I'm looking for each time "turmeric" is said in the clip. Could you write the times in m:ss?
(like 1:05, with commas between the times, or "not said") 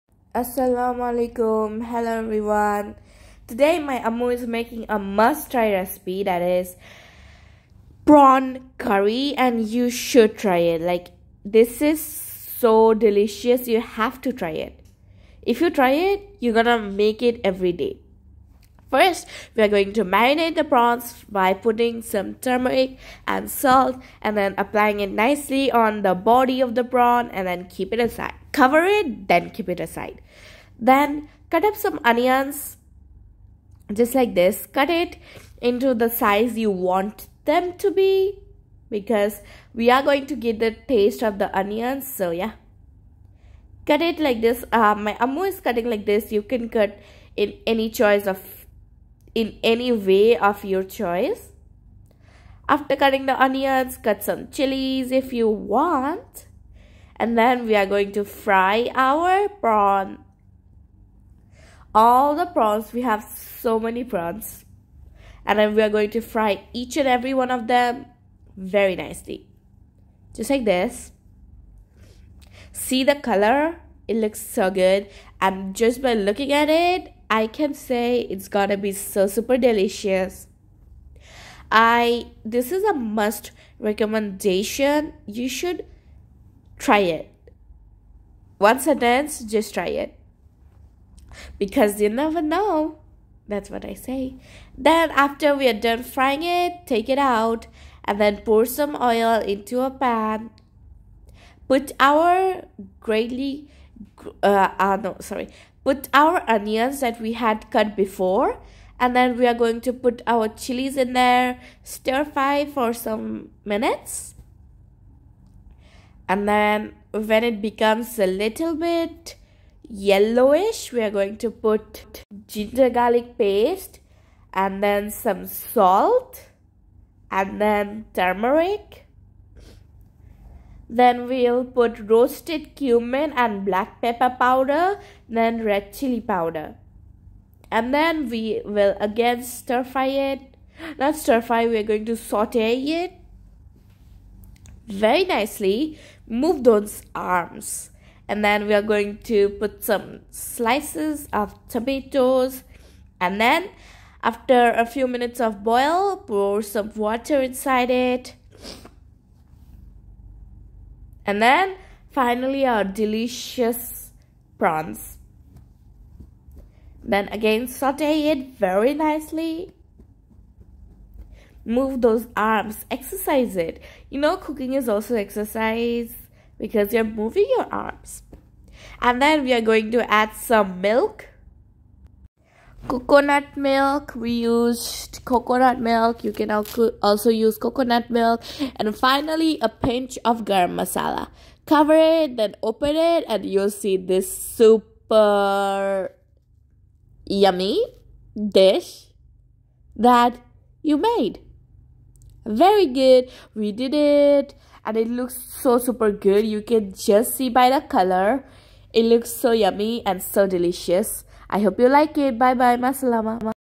0:22, 2:08.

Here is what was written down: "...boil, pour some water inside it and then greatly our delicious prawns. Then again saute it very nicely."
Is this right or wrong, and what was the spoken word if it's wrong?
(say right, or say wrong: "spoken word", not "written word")
wrong: "finally", not "greatly".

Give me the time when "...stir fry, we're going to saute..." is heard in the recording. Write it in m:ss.
2:21.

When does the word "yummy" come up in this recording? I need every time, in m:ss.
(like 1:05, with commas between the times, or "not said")
3:17, 3:29.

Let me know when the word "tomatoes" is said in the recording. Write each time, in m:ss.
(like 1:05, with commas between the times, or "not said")
2:31.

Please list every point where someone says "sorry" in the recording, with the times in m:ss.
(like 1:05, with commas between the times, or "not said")
1:45.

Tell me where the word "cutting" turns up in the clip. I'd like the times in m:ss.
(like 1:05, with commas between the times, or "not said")
0:45, 0:52.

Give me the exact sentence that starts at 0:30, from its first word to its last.
Then cut up some onions just like this.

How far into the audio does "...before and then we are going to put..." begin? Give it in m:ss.
1:47.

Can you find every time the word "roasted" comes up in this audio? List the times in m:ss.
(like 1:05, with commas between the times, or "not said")
2:12.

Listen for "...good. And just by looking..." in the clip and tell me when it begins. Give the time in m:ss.
1:14.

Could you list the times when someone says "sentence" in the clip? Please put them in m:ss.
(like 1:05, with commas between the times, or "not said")
1:28.